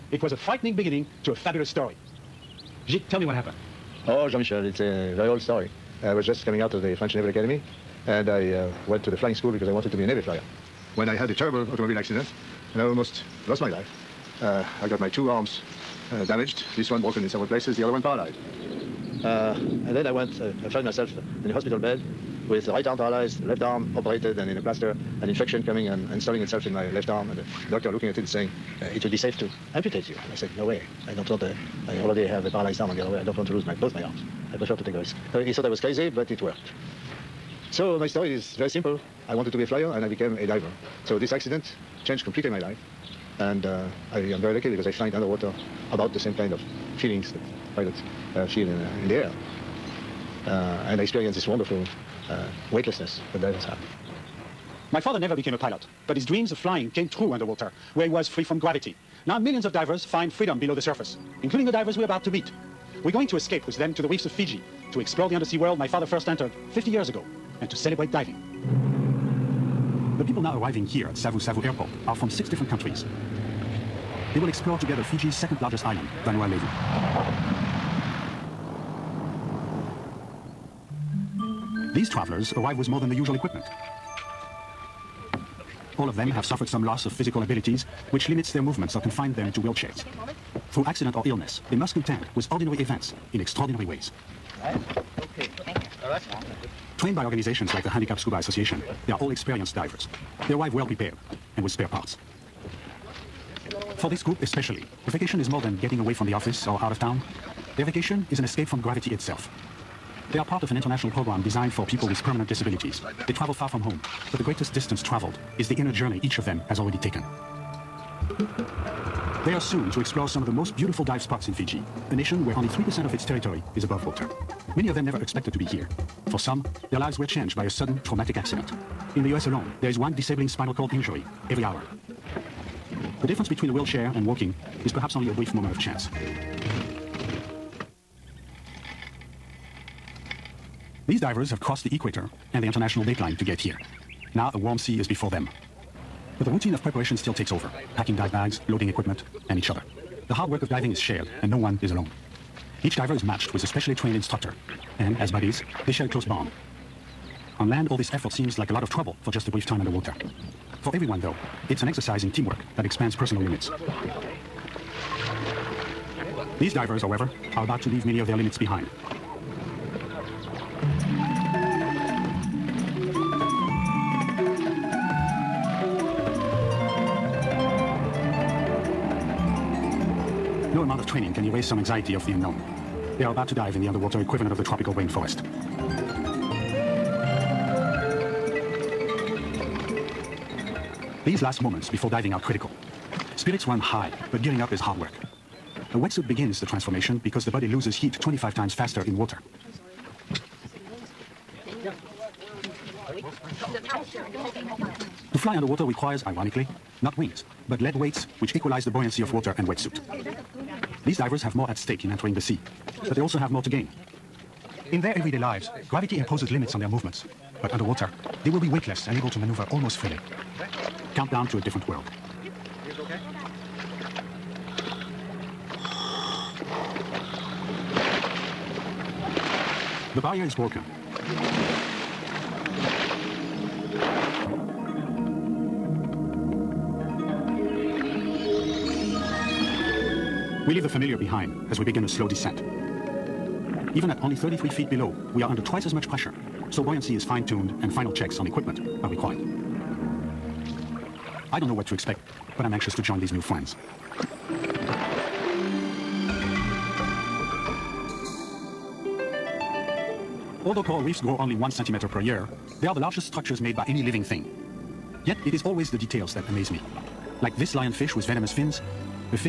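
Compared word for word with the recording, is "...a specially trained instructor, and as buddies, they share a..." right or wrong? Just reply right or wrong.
right.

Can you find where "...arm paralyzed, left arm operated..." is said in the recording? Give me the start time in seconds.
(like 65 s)
22 s.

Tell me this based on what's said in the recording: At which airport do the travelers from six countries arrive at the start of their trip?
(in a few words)
Savu Savu Airport.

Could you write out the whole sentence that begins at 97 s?
trained by organizations like the Handicapped Scuba Association, they are all experienced divers.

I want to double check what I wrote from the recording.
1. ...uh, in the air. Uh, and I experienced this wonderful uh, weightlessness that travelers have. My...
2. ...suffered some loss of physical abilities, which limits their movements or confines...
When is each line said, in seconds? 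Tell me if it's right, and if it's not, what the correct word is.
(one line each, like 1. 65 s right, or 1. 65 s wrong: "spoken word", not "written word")
1. 48 s wrong: "divers", not "travelers"
2. 86 s right.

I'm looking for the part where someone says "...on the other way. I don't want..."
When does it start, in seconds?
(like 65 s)
32 s.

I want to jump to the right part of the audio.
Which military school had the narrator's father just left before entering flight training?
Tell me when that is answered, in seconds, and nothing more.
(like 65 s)
6 s.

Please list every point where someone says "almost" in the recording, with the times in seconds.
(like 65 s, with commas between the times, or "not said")
12 s, 219 s.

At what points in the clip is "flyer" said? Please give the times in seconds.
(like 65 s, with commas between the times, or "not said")
10 s, 39 s.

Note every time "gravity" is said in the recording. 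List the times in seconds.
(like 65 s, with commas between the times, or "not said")
58 s, 108 s, 215 s.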